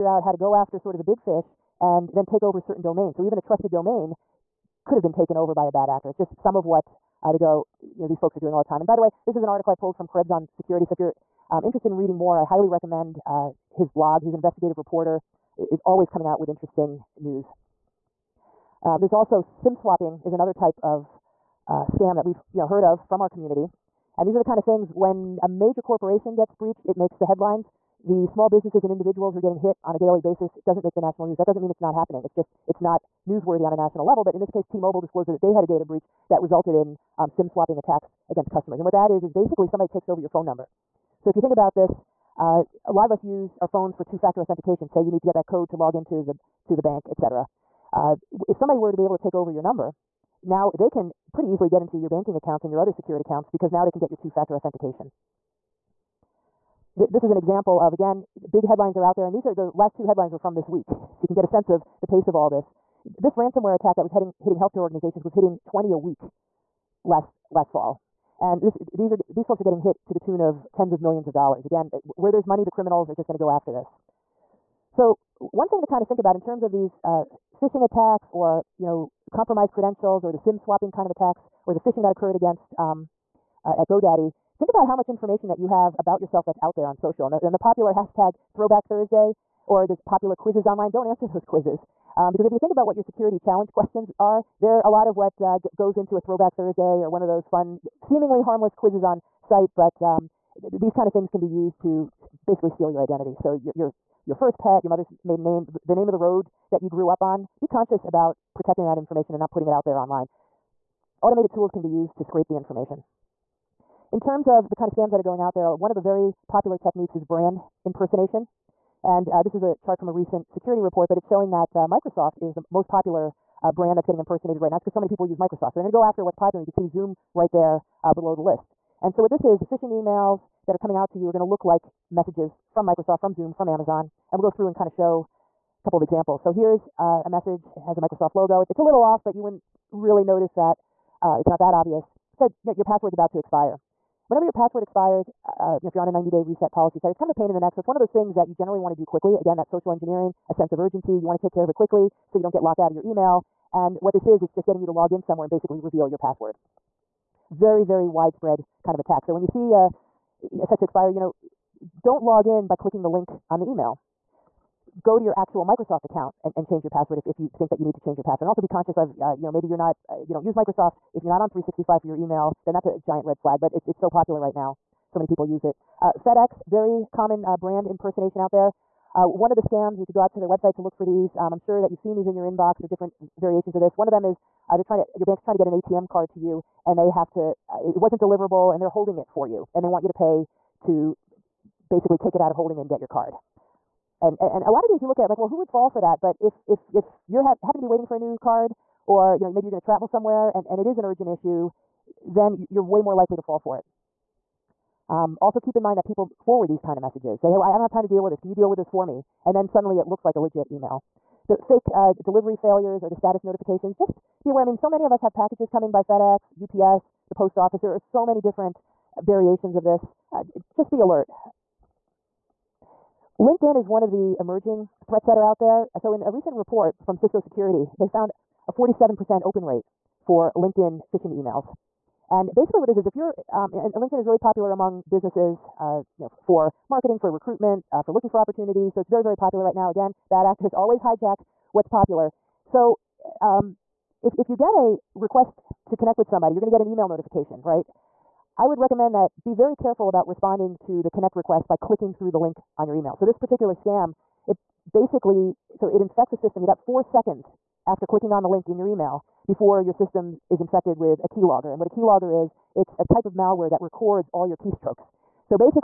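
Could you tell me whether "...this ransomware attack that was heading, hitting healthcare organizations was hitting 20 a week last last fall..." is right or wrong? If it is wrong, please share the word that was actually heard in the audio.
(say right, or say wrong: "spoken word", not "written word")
right.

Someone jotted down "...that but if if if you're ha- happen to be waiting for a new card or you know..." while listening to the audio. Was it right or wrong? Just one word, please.
right.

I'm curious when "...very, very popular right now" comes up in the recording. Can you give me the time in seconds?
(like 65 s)
239 s.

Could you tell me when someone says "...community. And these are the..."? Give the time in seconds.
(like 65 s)
23 s.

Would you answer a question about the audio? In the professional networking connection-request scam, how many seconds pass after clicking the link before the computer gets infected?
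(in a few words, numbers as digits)
4 seconds.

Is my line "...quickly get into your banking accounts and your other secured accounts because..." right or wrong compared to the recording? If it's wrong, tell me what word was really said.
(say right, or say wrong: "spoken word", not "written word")
wrong: "easily", not "quickly".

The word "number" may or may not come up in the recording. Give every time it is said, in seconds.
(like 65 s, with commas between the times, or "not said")
40 s, 49 s.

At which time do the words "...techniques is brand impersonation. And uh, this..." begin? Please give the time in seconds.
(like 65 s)
116 s.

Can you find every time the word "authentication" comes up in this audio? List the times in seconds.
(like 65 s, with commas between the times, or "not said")
44 s, 54 s.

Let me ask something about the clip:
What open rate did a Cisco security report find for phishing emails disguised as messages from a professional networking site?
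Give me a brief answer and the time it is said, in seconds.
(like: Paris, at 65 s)
47%, at 228 s.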